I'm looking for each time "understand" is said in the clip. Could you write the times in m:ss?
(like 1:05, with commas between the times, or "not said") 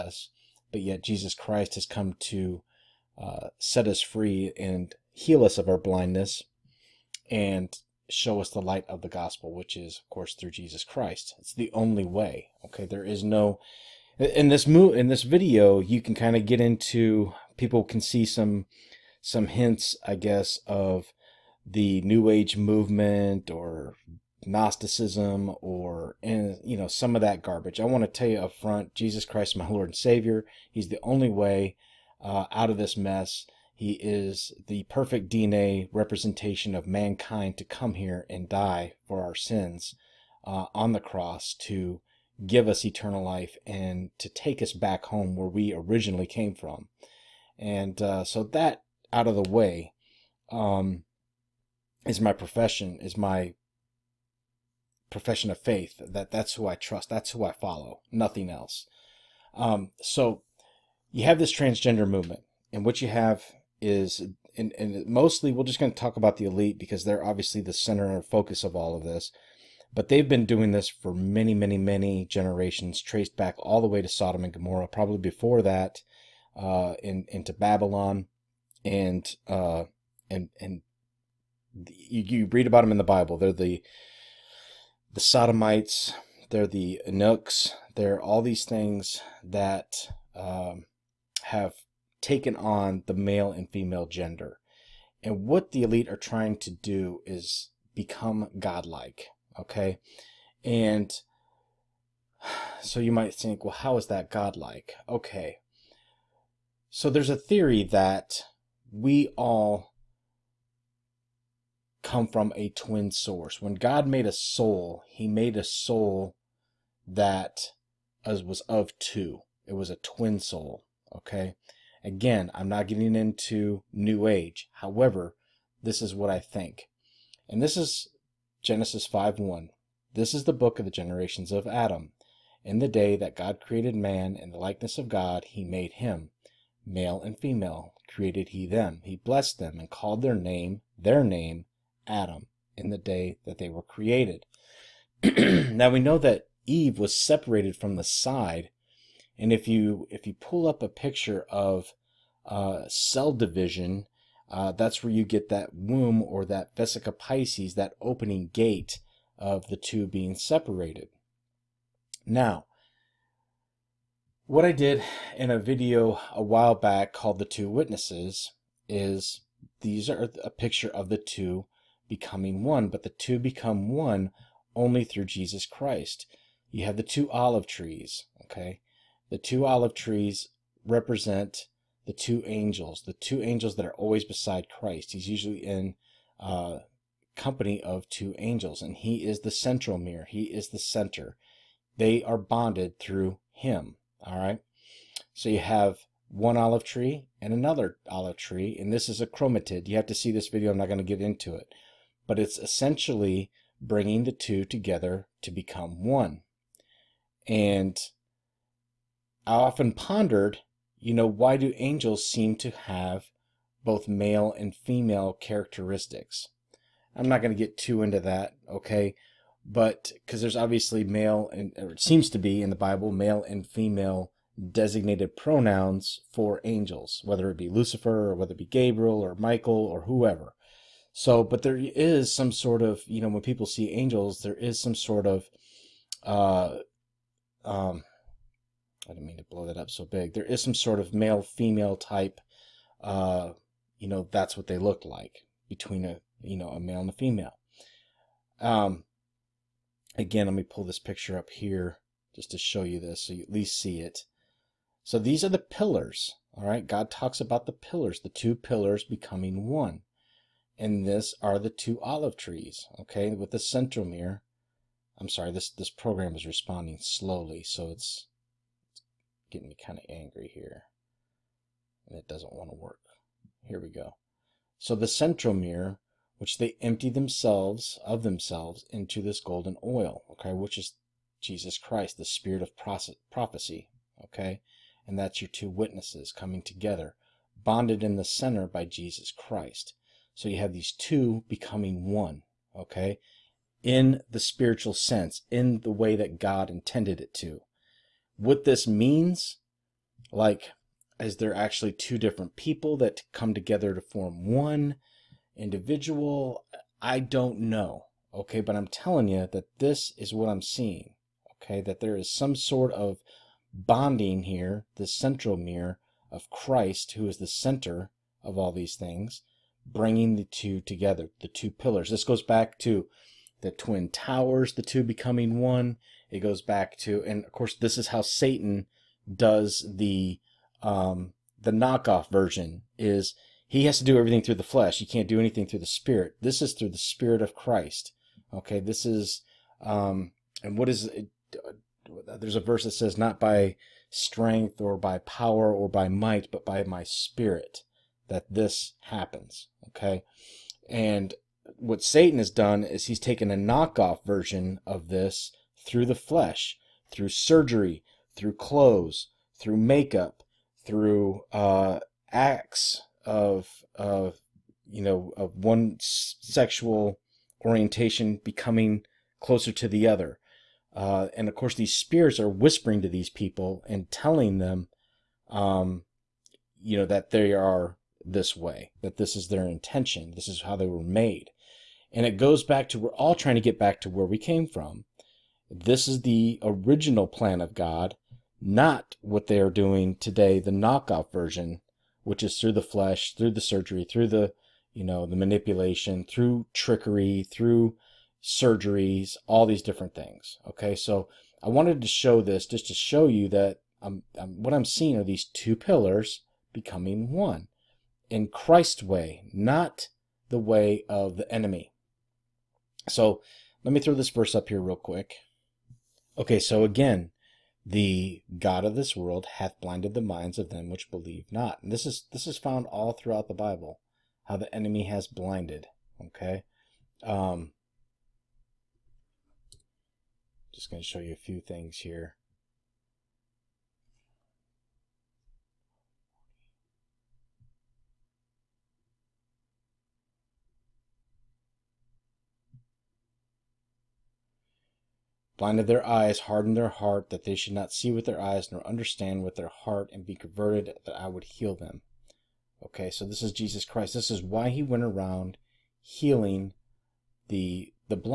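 7:28.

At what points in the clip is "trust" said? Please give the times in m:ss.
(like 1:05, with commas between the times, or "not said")
0:56.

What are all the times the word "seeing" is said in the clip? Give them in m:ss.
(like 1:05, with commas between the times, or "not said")
5:10, 6:44.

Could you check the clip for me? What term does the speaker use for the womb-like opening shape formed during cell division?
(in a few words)
vesica pisces.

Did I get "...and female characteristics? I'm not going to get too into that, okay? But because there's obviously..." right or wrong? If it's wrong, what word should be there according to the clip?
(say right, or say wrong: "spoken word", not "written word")
right.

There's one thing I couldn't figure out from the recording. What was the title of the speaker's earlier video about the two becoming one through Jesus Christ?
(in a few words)
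The Two Witnesses.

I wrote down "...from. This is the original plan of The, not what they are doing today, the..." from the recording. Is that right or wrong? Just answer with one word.
wrong.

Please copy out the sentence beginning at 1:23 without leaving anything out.
They're the the Sodomites, they're the eunuchs, they're all these things that um, have taken on the male and female gender.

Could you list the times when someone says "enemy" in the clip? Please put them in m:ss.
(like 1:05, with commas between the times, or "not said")
6:51, 7:04.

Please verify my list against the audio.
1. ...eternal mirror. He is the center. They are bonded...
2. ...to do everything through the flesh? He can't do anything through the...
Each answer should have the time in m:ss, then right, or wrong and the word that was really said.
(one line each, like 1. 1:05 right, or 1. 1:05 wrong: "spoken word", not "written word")
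1. 3:09 wrong: "central", not "eternal"
2. 5:33 right.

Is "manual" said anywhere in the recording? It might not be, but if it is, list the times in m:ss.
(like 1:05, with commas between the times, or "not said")
not said.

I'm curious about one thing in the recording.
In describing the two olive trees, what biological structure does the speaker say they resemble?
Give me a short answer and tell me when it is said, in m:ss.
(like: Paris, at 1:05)
chromatid, at 3:19.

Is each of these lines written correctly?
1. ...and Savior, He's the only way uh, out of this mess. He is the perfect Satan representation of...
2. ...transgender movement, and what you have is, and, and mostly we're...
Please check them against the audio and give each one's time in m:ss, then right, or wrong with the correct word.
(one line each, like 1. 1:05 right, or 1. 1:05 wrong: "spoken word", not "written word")
1. 0:29 wrong: "DNA", not "Satan"
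2. 1:01 right.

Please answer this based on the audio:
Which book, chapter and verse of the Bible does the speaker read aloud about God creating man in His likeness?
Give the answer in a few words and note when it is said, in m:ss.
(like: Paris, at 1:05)
Genesis 5:1, at 2:08.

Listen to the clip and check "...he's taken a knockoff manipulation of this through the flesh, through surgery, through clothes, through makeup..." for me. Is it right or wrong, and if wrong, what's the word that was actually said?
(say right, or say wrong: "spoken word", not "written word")
wrong: "version", not "manipulation".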